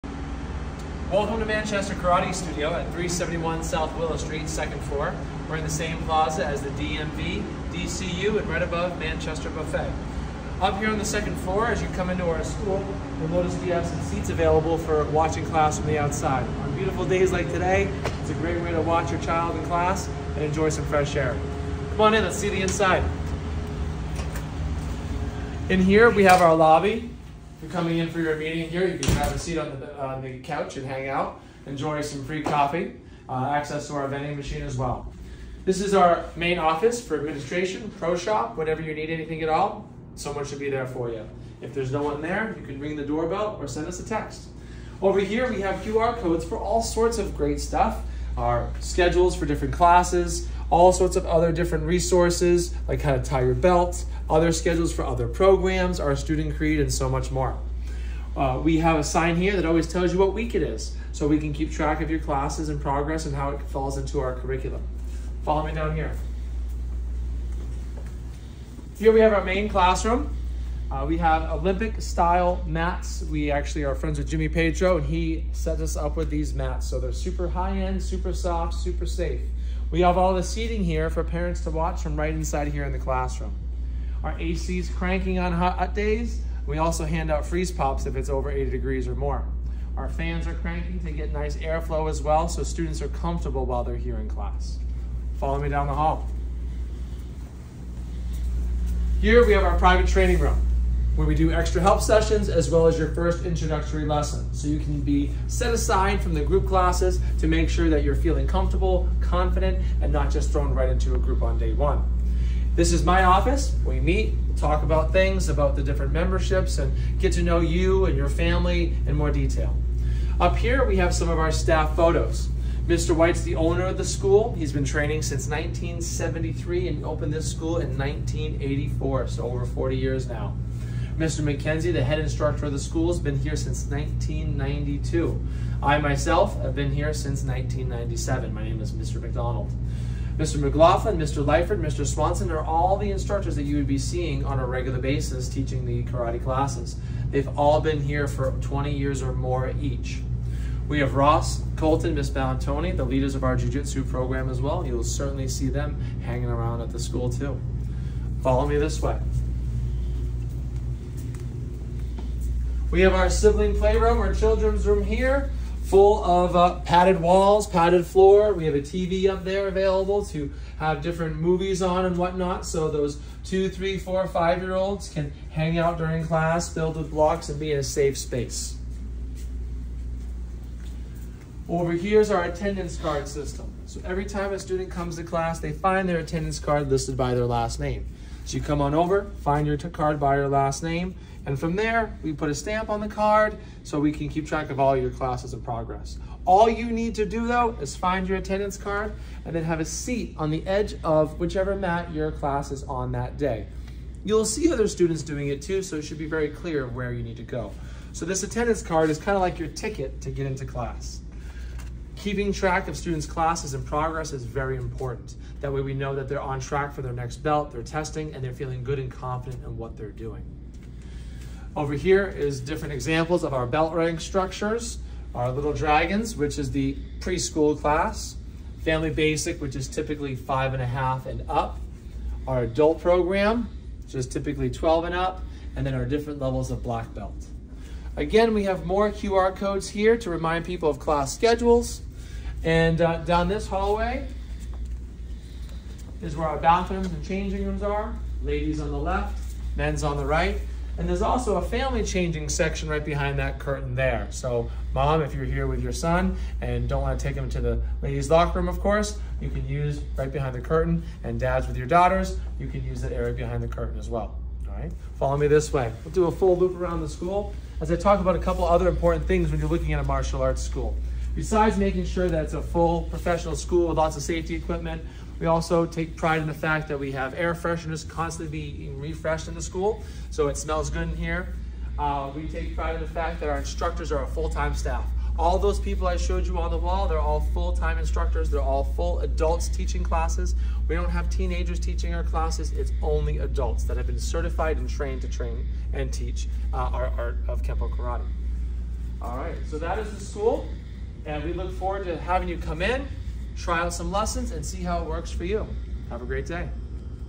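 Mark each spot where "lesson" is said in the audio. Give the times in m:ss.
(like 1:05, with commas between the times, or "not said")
1:44, 5:04.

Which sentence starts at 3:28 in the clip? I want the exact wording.
So this attendance card is kind of like your ticket to get into class.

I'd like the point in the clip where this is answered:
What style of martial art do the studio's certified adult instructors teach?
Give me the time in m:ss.
4:57.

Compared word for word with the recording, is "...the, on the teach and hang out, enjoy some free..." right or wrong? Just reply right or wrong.
wrong.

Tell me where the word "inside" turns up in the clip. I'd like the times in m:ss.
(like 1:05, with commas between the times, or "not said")
0:22, 1:22.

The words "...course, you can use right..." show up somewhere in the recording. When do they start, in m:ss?
4:18.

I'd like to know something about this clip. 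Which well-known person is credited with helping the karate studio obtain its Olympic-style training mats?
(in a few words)
Jimmy Pedro.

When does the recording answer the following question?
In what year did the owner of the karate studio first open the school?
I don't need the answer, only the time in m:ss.
2:07.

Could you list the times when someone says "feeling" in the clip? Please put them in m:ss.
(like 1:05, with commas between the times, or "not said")
1:48, 3:38.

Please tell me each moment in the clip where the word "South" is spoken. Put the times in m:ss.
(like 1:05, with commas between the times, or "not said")
0:03.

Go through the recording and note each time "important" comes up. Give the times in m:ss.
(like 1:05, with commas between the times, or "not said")
3:34, 4:28.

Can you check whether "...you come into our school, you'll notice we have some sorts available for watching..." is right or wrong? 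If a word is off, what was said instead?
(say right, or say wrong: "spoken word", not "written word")
wrong: "seats", not "sorts".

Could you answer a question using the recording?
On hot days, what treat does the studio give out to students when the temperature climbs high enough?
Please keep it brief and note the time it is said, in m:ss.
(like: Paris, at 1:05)
freeze pops, at 1:27.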